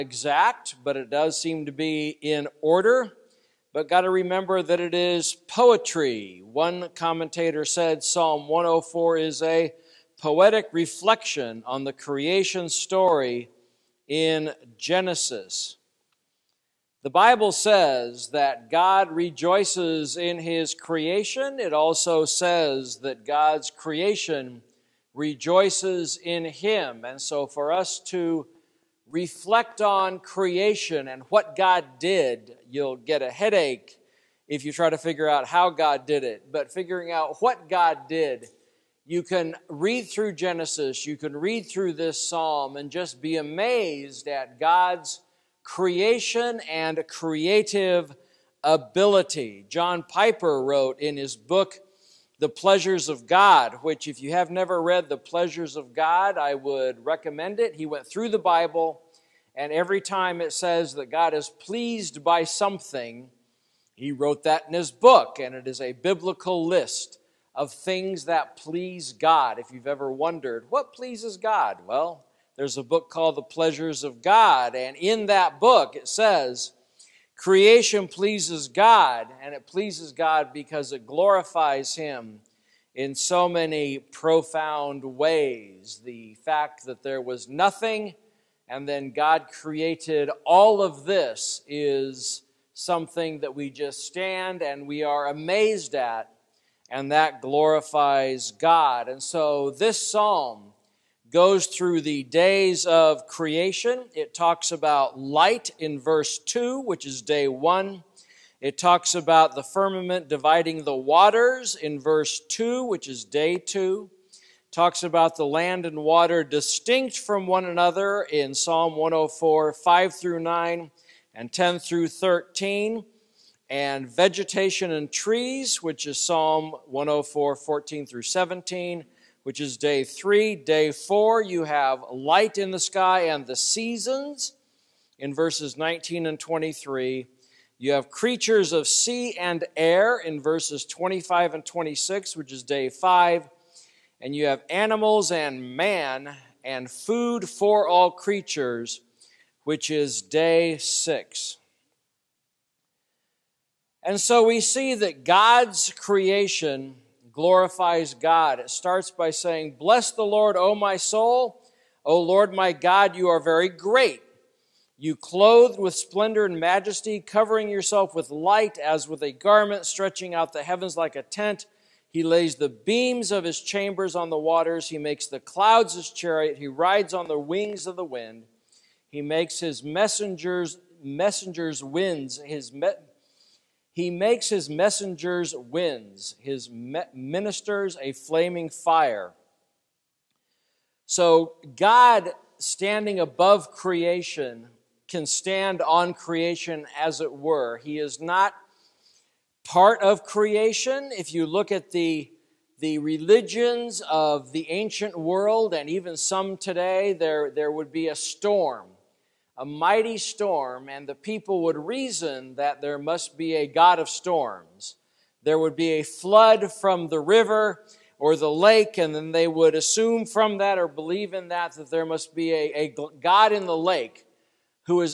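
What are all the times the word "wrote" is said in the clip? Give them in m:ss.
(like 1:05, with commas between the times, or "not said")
0:50, 1:04.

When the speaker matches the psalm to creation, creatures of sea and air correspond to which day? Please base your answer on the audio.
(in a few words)
Day five.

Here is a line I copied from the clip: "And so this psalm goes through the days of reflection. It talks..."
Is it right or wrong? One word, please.
wrong.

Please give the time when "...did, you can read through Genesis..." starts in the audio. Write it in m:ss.
0:38.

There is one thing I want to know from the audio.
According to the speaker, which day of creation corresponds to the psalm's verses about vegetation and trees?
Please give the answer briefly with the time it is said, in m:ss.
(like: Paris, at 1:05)
Day three, at 2:09.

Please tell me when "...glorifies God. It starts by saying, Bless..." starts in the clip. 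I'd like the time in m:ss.
2:37.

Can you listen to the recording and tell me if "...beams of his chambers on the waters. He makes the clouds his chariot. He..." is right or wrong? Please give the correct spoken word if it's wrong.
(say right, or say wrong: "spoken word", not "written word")
right.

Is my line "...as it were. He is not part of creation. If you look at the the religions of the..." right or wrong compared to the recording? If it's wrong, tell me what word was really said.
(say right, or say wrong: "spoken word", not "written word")
right.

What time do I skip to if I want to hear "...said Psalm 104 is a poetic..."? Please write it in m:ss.
0:07.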